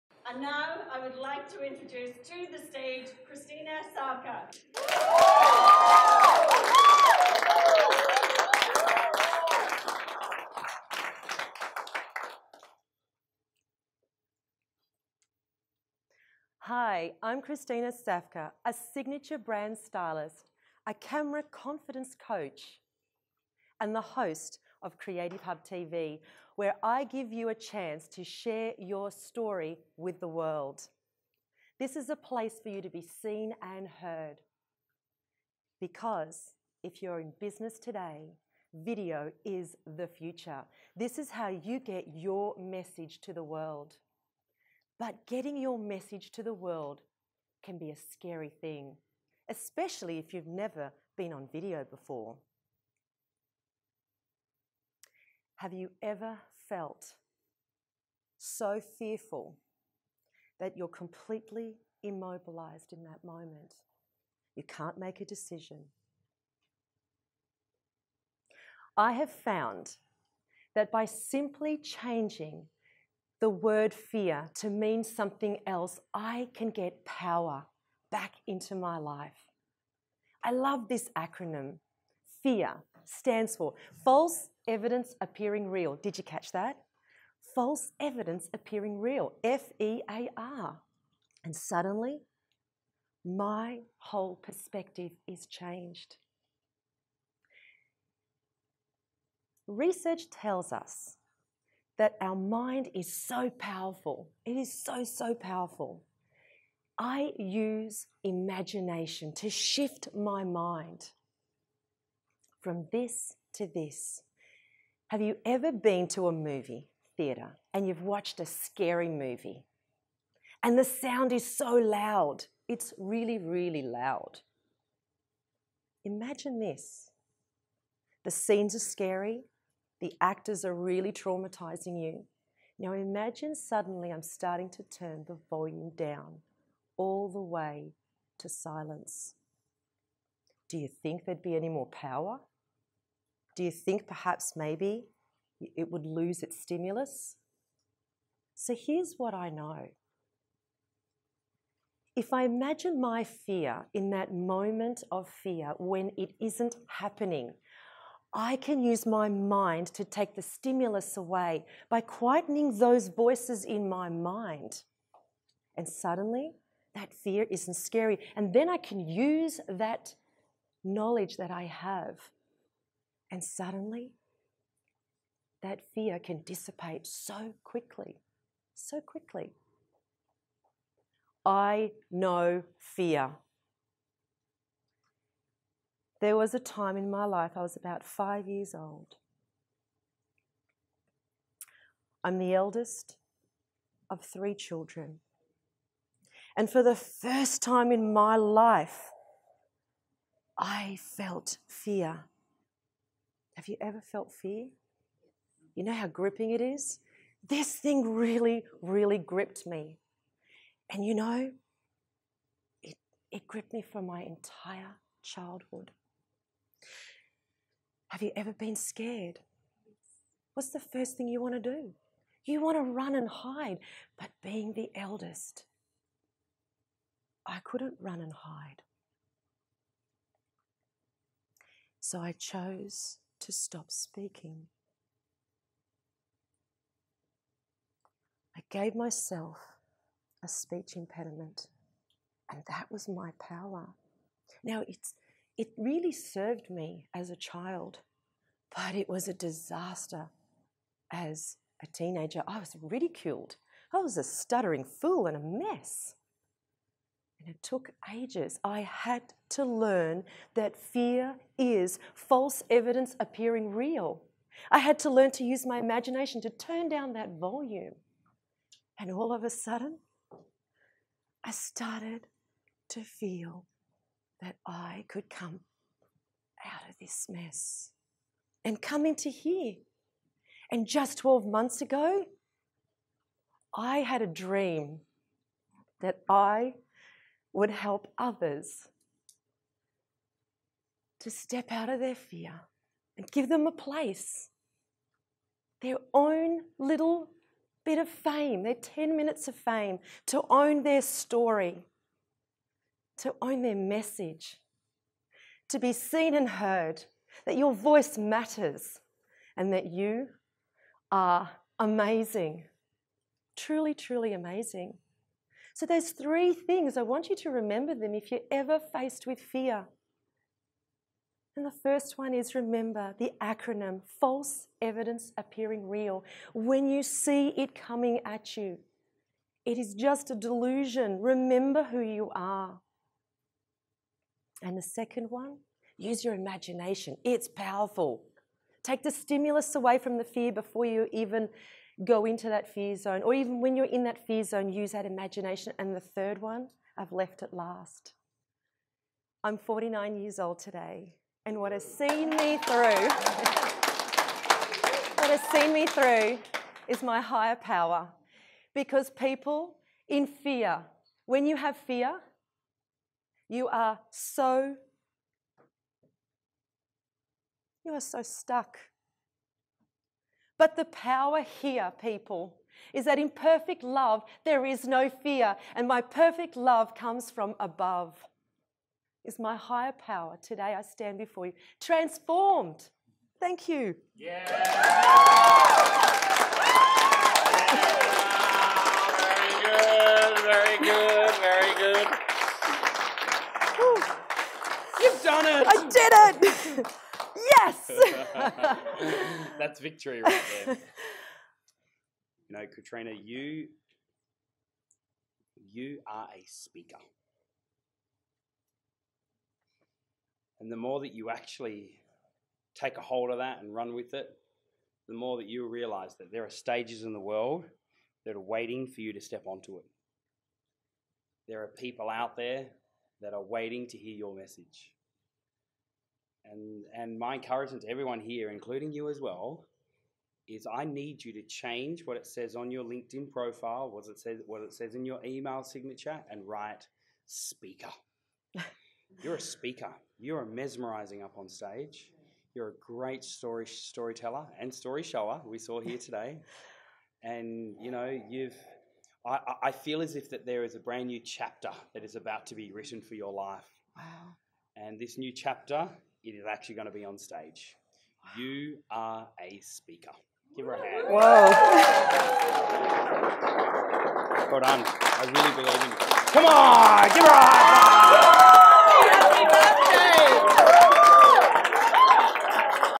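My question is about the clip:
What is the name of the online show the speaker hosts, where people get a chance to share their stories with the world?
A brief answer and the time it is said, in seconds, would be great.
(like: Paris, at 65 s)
Creative Hub TV, at 24 s.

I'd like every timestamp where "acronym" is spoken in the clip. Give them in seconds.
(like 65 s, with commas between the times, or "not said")
81 s, 323 s.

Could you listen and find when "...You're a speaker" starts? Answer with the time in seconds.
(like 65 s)
439 s.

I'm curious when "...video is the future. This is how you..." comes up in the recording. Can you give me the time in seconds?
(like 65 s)
38 s.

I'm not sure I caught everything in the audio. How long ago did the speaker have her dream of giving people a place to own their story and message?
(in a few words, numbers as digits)
12 months.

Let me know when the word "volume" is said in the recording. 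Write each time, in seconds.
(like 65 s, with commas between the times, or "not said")
135 s, 267 s.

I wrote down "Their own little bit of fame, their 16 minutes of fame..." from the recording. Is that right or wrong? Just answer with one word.
wrong.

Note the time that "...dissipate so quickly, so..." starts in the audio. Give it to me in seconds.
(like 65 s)
176 s.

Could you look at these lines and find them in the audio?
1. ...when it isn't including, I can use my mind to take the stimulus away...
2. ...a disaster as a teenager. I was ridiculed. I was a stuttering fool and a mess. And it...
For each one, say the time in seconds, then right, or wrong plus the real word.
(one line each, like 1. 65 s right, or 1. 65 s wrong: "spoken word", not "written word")
1. 155 s wrong: "happening", not "including"
2. 249 s right.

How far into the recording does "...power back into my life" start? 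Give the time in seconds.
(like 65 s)
77 s.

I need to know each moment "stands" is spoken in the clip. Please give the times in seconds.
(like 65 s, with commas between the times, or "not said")
83 s, 380 s.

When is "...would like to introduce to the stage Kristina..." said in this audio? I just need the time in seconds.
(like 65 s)
1 s.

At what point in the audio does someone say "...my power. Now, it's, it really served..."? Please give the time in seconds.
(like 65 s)
243 s.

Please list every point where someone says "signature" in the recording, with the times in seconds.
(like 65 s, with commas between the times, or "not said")
18 s, 435 s.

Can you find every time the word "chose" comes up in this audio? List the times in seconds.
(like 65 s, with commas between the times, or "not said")
232 s.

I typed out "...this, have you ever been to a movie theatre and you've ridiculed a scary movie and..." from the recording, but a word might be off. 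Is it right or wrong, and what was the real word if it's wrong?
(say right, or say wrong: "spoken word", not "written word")
wrong: "watched", not "ridiculed".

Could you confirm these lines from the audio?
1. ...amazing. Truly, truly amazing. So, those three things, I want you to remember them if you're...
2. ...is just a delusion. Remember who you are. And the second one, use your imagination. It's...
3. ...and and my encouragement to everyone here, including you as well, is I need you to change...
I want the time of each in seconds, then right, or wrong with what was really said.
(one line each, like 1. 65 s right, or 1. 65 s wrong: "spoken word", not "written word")
1. 311 s right
2. 329 s right
3. 426 s right.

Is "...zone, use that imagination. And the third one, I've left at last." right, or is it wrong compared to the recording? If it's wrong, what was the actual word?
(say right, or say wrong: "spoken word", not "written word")
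right.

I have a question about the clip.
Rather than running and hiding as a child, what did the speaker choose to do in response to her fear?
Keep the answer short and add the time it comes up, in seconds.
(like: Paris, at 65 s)
Stop speaking, at 233 s.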